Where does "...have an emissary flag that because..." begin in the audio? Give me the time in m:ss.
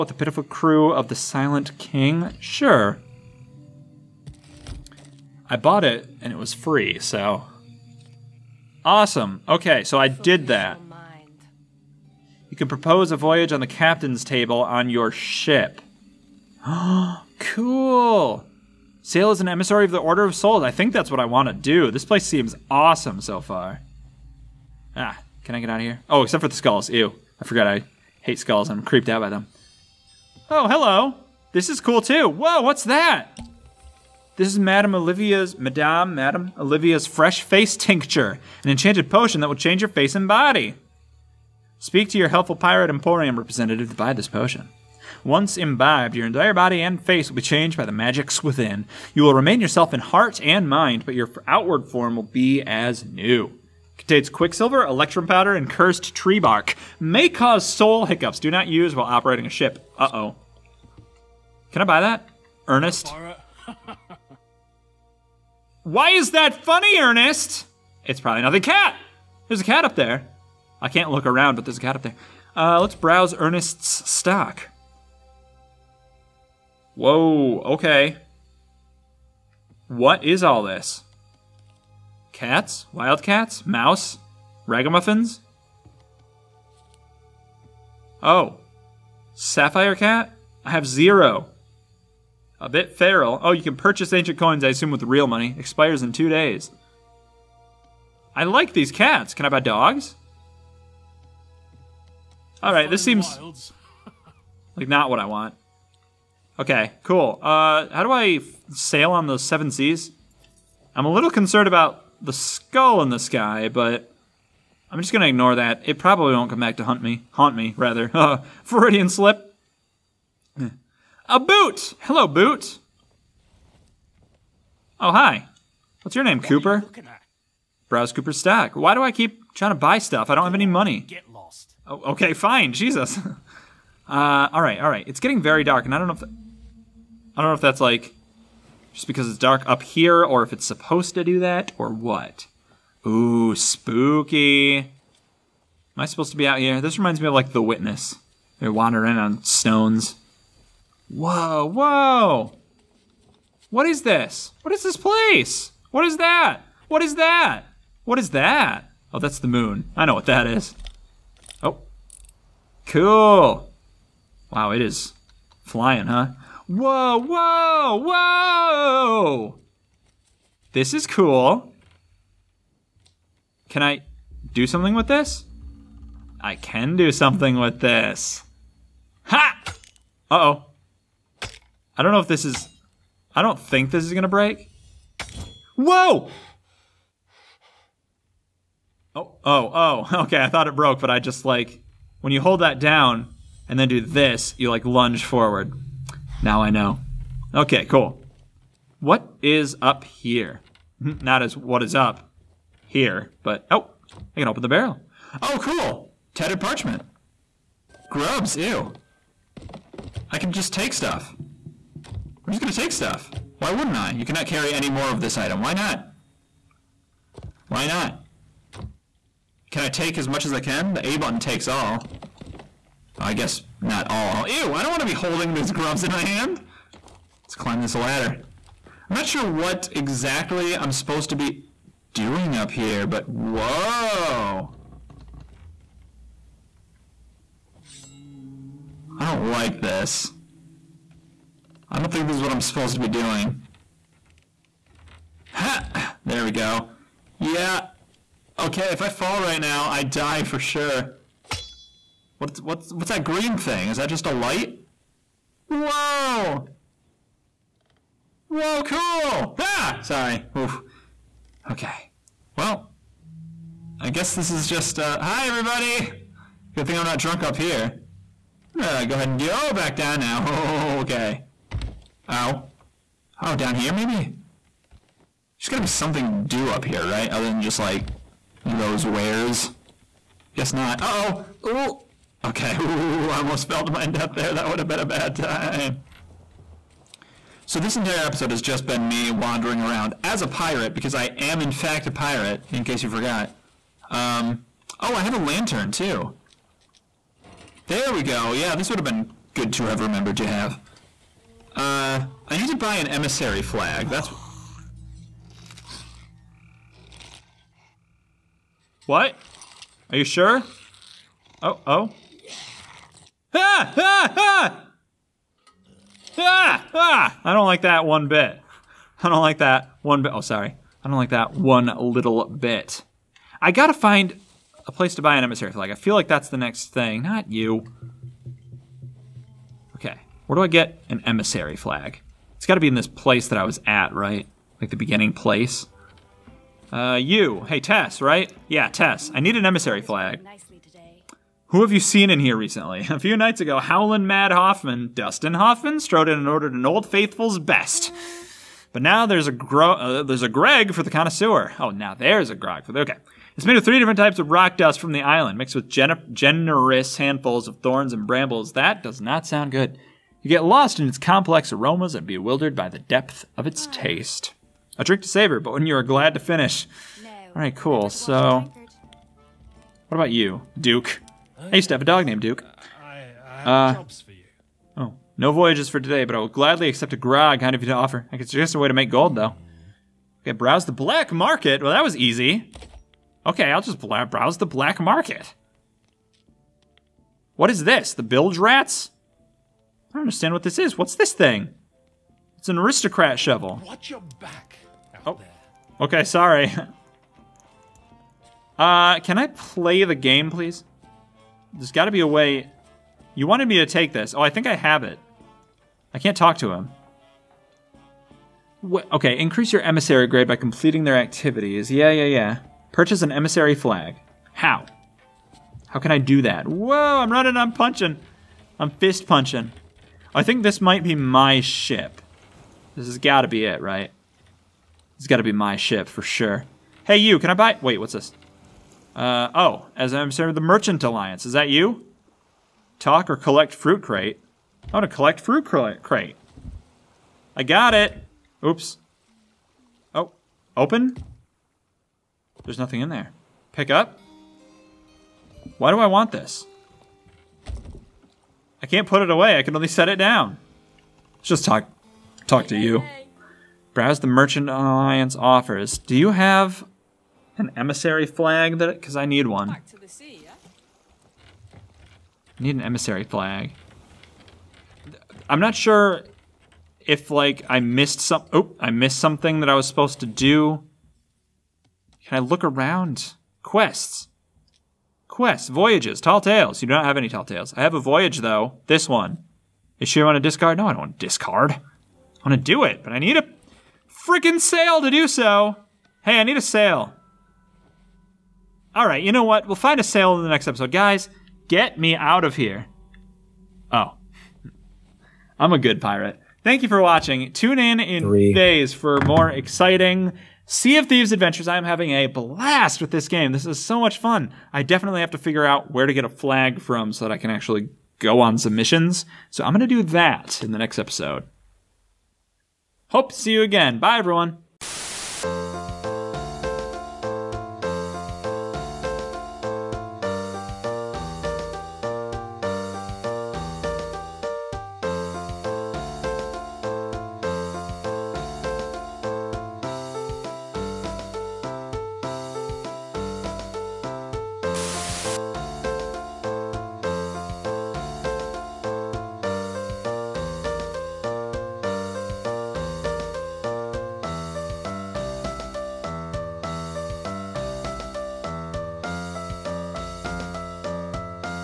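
7:36.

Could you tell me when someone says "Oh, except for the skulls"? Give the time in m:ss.
0:26.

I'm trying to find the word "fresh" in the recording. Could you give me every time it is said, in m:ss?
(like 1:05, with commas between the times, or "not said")
0:37.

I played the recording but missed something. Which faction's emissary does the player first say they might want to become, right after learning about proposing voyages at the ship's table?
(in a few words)
Order of Souls.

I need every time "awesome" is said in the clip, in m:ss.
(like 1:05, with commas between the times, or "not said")
0:08, 0:22.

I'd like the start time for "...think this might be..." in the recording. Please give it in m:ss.
7:00.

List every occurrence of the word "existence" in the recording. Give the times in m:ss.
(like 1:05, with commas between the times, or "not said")
not said.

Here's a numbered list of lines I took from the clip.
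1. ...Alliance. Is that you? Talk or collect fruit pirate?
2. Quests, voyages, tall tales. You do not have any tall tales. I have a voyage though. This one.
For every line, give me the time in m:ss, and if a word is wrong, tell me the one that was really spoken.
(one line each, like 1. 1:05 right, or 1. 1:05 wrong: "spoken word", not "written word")
1. 7:11 wrong: "crate", not "pirate"
2. 7:55 right.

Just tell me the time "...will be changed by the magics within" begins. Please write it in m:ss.
0:47.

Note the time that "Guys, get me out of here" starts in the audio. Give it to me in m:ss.
8:10.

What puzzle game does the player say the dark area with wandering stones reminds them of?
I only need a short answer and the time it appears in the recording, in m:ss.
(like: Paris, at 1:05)
The Witness, at 2:27.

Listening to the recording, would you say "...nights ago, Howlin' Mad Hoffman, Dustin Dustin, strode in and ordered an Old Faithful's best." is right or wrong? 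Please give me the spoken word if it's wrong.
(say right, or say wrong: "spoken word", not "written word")
wrong: "Hoffman", not "Dustin".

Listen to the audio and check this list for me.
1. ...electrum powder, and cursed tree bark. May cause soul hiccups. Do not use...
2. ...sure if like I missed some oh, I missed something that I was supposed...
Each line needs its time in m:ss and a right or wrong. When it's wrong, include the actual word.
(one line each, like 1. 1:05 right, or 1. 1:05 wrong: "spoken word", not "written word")
1. 0:54 right
2. 7:45 right.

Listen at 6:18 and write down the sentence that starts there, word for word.
I could suggest a way to make gold, though.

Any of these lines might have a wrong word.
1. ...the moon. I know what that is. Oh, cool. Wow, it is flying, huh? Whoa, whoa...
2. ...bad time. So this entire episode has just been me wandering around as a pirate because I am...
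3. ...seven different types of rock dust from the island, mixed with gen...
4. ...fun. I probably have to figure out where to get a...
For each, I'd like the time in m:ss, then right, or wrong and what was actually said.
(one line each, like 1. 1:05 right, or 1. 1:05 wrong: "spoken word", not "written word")
1. 2:39 right
2. 4:45 right
3. 5:53 wrong: "three", not "seven"
4. 8:24 wrong: "definitely", not "probably".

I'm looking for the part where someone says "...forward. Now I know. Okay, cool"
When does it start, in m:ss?
3:15.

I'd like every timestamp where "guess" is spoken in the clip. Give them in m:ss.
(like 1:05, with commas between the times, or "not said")
3:43, 4:24, 4:40.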